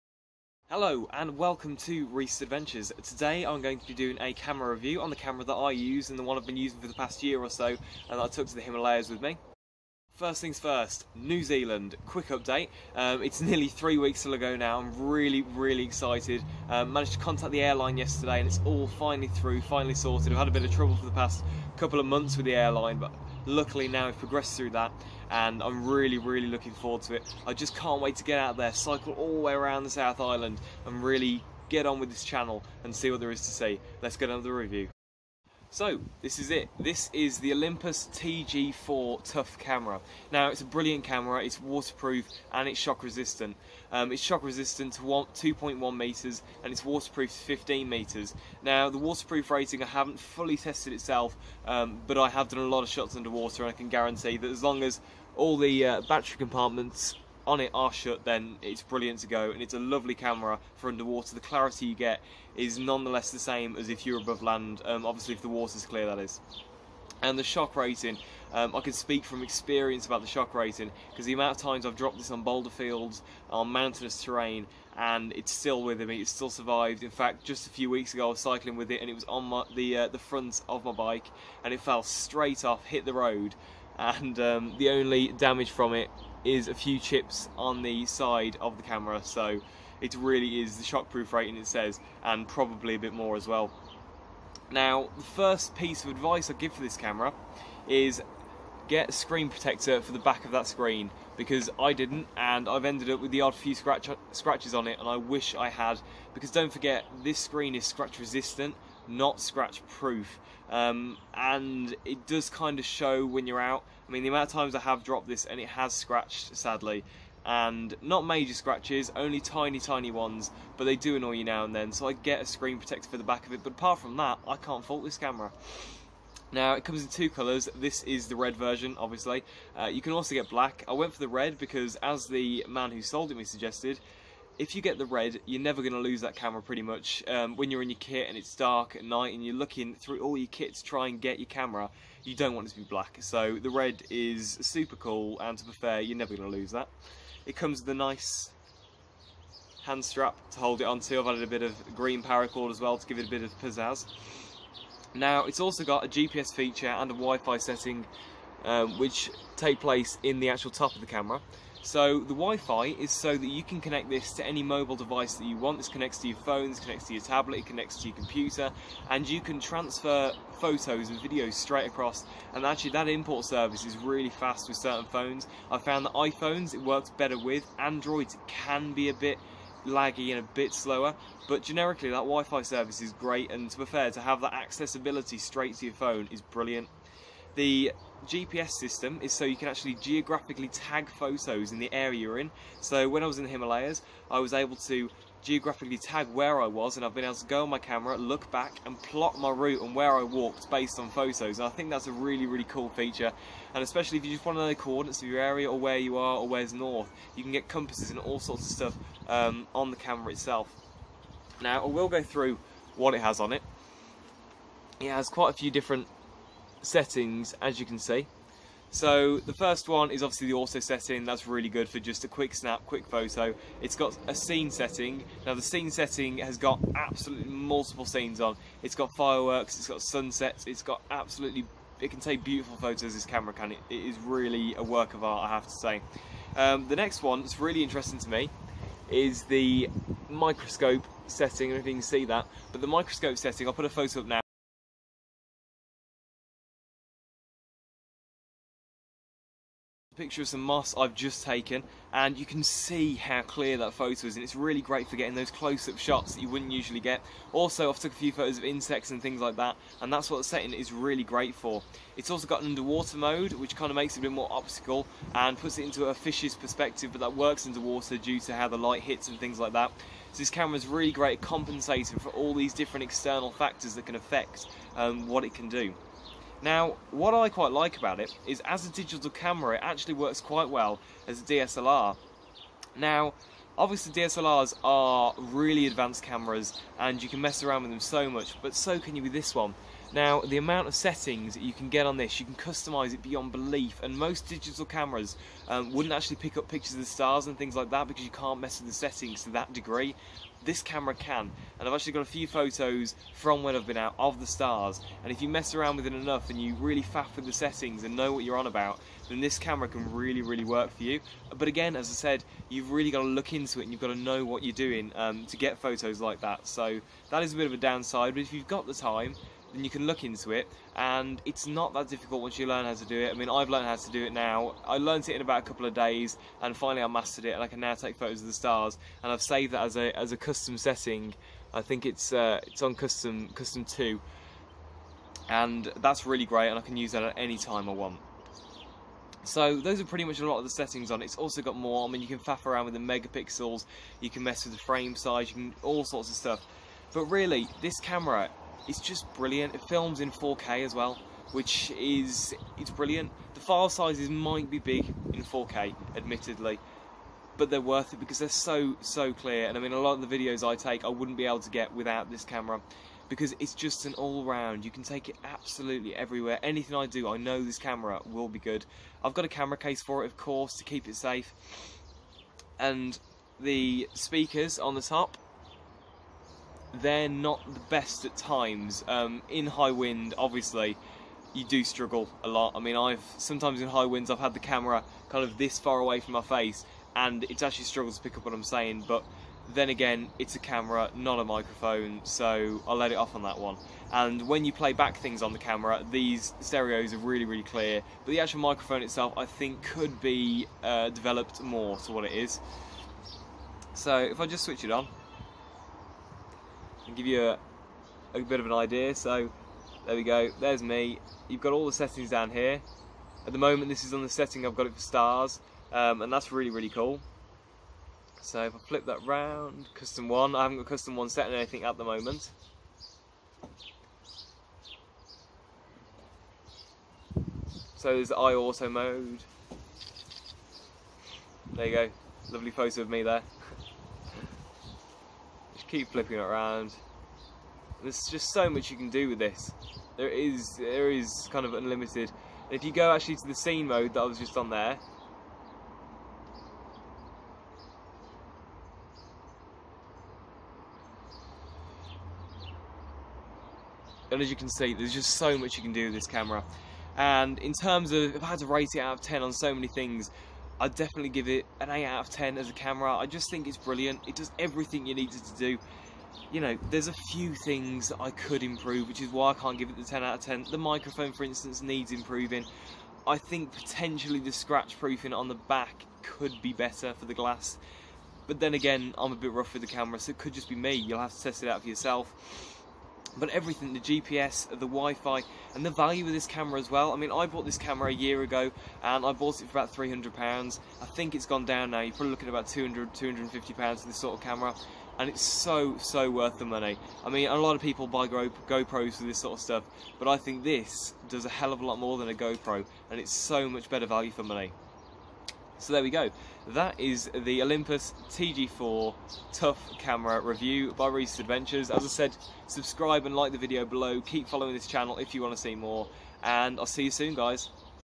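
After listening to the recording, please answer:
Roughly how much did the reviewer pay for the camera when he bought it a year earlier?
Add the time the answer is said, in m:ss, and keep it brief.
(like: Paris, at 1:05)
300 pounds, at 8:09.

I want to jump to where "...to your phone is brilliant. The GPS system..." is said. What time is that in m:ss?
3:05.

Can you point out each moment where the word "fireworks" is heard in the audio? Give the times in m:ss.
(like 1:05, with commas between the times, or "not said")
3:49.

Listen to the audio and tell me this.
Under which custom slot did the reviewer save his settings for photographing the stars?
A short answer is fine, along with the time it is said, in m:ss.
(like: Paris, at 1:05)
Custom 2, at 5:33.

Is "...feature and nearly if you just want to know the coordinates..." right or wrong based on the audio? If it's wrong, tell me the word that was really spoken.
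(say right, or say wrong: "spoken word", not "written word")
wrong: "especially", not "nearly".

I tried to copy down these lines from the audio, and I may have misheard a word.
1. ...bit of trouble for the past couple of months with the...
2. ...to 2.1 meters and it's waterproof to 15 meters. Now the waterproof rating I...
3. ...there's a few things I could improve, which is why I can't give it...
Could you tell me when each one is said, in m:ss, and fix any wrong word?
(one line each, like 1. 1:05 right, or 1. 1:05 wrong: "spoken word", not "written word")
1. 0:20 right
2. 0:44 right
3. 7:46 right.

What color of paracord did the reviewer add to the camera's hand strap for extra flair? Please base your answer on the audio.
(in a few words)
Green.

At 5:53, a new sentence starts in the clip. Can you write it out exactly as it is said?
The file sizes might be big in 4K, admittedly, but they're worth it because they're so so clear.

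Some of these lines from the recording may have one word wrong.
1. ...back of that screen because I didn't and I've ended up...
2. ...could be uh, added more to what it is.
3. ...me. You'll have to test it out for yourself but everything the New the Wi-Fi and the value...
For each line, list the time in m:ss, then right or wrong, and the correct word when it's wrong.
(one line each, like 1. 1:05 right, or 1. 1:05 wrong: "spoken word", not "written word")
1. 1:40 right
2. 6:39 wrong: "developed", not "added"
3. 8:00 wrong: "GPS", not "New".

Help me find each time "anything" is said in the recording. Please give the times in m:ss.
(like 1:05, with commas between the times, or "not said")
6:06, 7:01.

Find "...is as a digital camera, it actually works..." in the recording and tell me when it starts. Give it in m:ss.
4:38.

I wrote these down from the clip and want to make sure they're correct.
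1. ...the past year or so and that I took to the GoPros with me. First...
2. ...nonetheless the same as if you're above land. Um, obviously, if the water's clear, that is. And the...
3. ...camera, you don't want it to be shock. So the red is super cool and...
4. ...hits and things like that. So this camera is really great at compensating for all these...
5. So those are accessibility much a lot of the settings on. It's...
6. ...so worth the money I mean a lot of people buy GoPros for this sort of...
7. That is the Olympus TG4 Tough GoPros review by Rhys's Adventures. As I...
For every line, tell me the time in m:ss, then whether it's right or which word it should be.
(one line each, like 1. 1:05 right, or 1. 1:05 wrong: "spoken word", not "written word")
1. 0:06 wrong: "Himalayas", not "GoPros"
2. 1:02 right
3. 2:21 wrong: "black", not "shock"
4. 4:29 right
5. 5:39 wrong: "pretty", not "accessibility"
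6. 8:15 right
7. 8:26 wrong: "Camera", not "GoPros".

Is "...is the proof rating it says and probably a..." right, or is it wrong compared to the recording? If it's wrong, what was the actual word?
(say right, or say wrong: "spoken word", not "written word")
wrong: "shockproof", not "proof".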